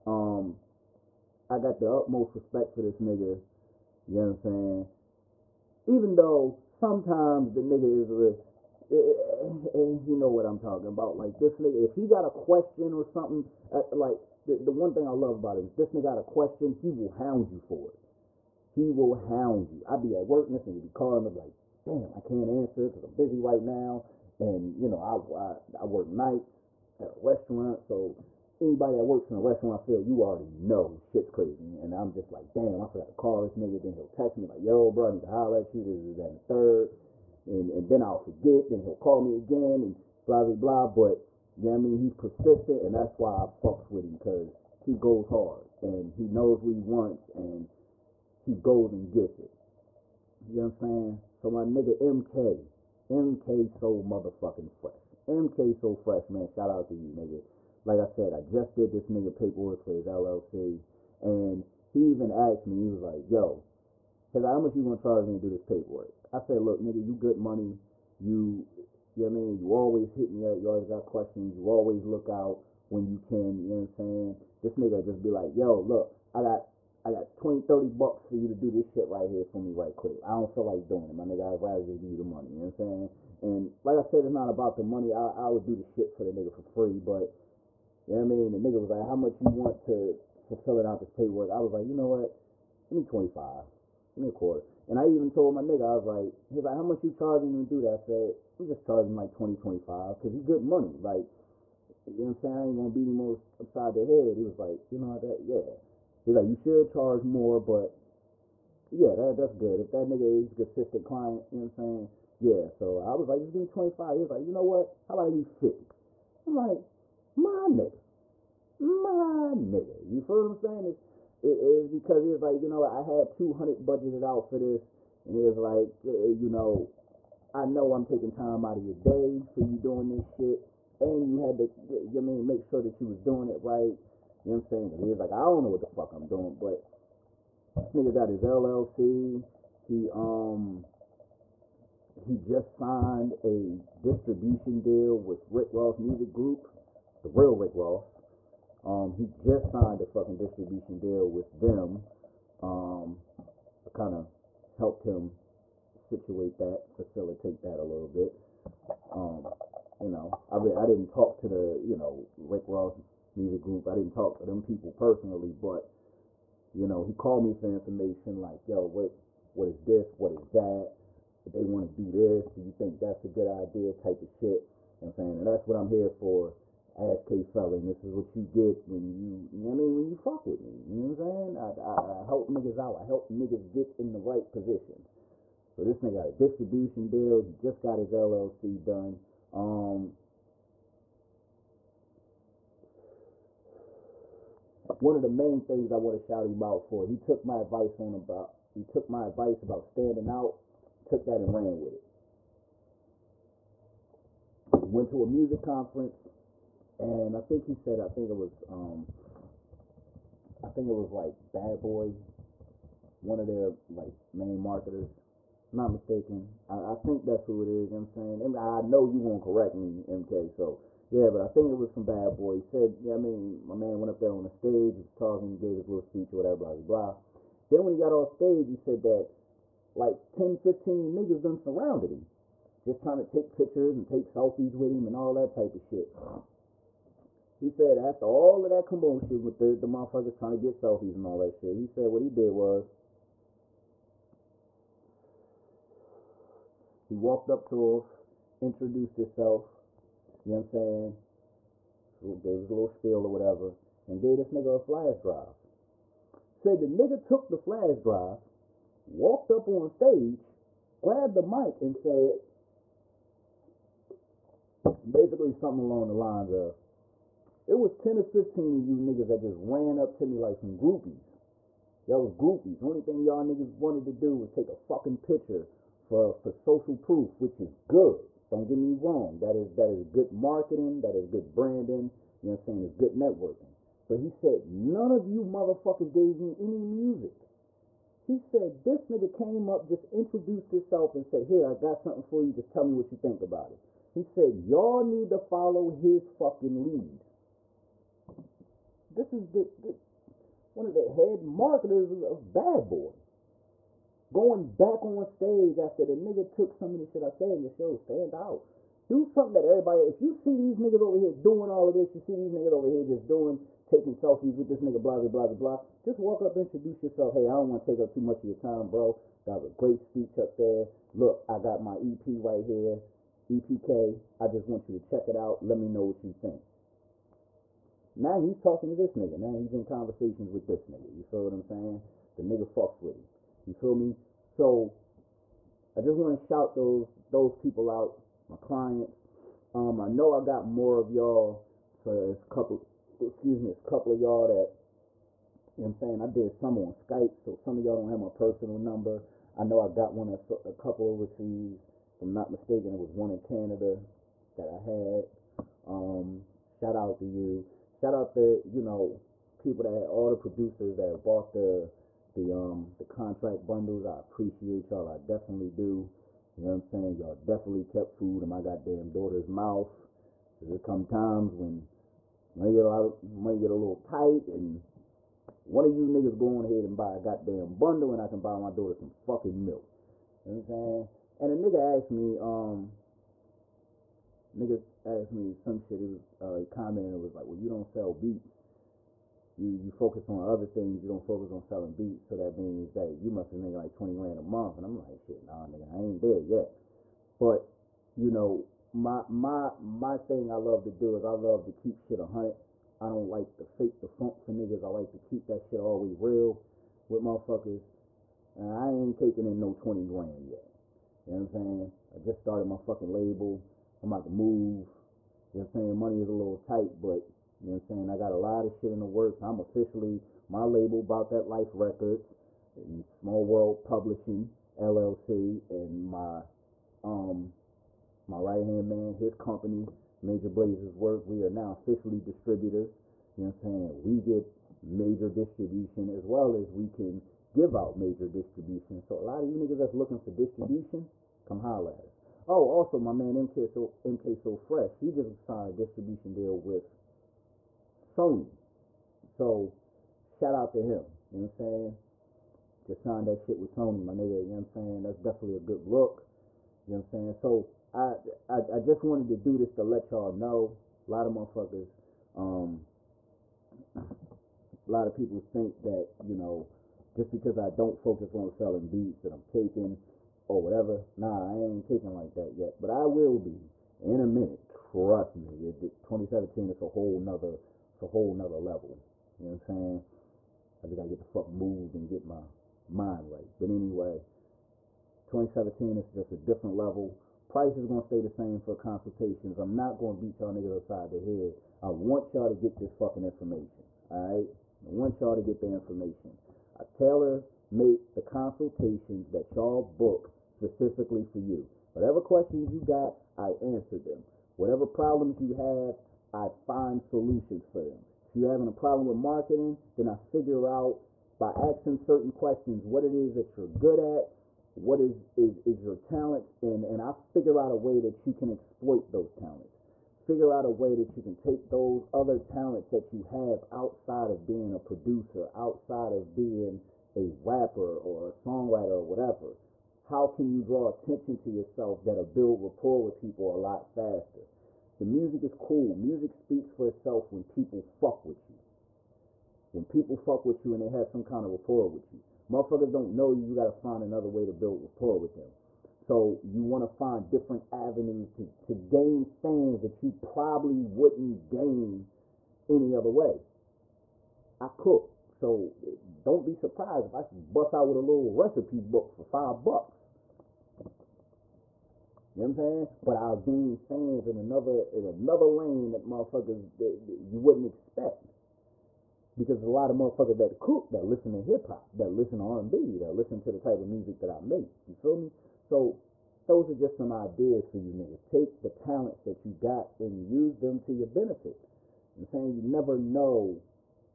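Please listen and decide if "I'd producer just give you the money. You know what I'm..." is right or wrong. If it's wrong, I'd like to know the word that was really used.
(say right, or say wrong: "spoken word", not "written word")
wrong: "rather", not "producer".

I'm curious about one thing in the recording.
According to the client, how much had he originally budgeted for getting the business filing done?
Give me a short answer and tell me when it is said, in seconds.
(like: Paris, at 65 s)
200, at 123 s.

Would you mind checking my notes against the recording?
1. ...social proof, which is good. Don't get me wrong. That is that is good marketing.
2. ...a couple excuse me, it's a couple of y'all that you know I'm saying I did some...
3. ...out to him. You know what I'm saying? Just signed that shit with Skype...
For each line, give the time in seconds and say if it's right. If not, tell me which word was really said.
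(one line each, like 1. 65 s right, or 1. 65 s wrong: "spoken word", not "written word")
1. 276 s right
2. 342 s right
3. 450 s wrong: "Sony", not "Skype".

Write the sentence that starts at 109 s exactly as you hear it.
If that nigga he's a consistent client, you know what I'm saying?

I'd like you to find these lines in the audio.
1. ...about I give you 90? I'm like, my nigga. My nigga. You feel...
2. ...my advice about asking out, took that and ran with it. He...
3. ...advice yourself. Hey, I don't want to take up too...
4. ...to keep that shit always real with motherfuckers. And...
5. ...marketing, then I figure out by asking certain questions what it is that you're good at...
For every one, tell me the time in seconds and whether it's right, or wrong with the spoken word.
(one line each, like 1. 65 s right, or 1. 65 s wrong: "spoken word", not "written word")
1. 115 s wrong: "50", not "90"
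2. 199 s wrong: "standing", not "asking"
3. 316 s wrong: "introduce", not "advice"
4. 405 s right
5. 509 s right.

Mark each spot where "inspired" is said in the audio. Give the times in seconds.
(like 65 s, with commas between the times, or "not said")
not said.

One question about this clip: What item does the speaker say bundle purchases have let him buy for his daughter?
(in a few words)
Milk.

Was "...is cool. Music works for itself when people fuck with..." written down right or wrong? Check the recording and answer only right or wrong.
wrong.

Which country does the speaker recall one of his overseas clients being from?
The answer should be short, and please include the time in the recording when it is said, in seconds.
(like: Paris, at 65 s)
Canada, at 353 s.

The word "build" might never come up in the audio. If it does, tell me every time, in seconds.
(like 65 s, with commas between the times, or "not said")
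532 s, 544 s.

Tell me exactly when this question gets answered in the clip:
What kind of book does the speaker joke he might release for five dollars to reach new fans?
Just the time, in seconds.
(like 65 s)
558 s.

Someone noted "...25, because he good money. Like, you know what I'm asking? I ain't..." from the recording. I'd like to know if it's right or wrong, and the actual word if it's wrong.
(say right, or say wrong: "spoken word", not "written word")
wrong: "saying", not "asking".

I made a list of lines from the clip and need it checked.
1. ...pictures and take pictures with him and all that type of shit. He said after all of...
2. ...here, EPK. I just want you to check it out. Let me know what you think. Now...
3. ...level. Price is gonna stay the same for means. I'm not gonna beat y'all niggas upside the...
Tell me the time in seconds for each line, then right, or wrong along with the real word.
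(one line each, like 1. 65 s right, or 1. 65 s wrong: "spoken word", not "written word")
1. 233 s wrong: "selfies", not "pictures"
2. 322 s right
3. 486 s wrong: "consultations", not "means".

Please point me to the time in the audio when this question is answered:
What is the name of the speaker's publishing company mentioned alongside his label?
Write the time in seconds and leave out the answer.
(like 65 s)
423 s.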